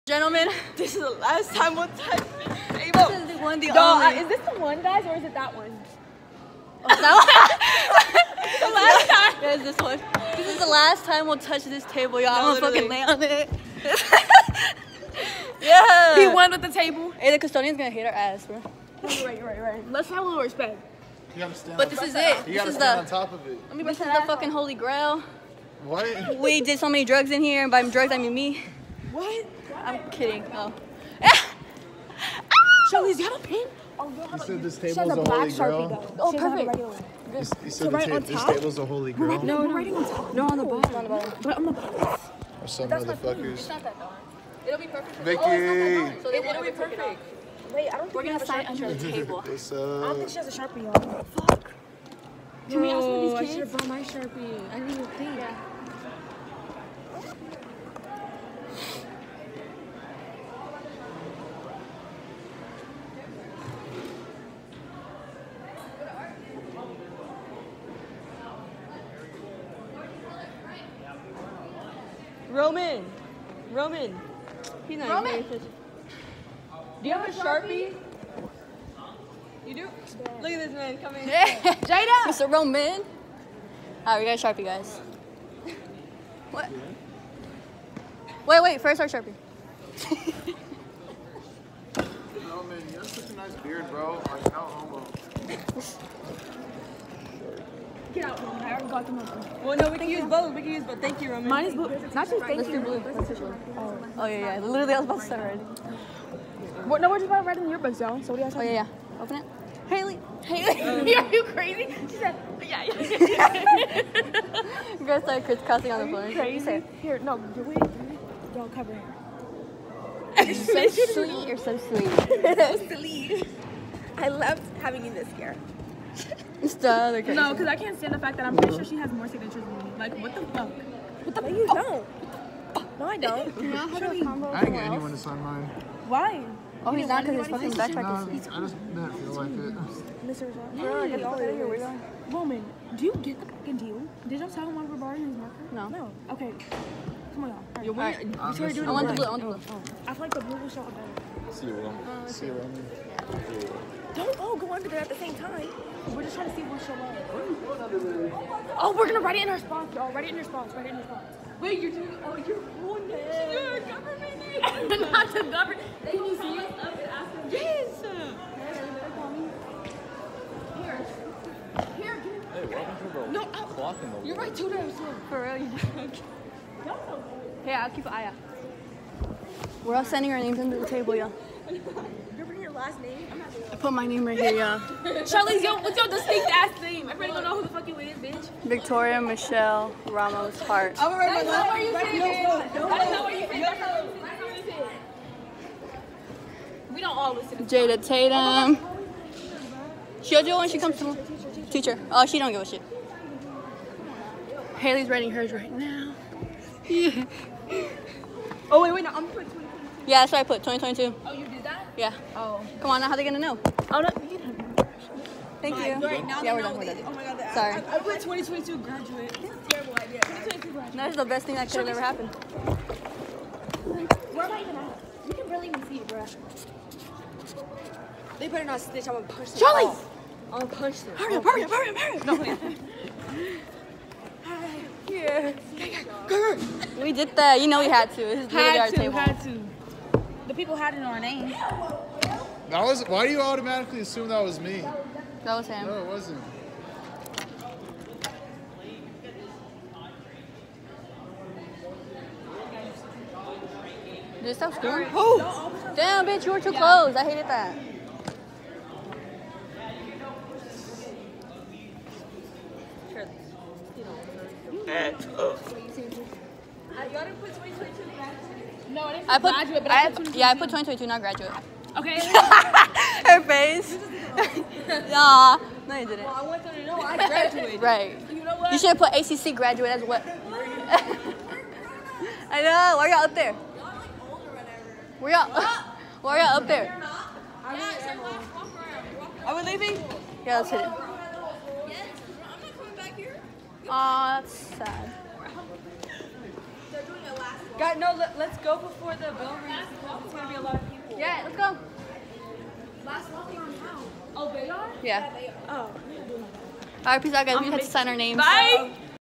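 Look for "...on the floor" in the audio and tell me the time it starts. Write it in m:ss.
1:55.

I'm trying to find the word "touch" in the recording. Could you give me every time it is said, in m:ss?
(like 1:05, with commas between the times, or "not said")
0:01, 0:11.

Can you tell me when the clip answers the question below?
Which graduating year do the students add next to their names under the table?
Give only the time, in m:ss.
3:29.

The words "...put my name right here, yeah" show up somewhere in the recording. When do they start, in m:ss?
3:03.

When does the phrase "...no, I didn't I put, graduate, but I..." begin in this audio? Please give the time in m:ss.
4:28.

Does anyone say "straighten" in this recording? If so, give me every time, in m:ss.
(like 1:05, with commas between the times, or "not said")
not said.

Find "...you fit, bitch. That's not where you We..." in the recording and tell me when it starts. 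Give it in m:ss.
3:11.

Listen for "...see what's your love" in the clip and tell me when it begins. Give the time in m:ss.
2:36.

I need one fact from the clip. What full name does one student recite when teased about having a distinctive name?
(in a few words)
Victoria Michelle Ramos Hart.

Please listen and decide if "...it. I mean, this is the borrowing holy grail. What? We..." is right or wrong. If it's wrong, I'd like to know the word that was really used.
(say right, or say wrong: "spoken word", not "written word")
wrong: "fucking", not "borrowing".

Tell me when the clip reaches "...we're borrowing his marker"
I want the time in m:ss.
2:24.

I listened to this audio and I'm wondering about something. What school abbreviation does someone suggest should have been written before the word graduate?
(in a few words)
ACC.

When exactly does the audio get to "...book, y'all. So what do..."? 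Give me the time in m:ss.
1:47.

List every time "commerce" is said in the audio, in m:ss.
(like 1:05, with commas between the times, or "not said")
not said.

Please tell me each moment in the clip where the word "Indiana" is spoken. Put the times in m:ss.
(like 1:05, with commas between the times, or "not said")
not said.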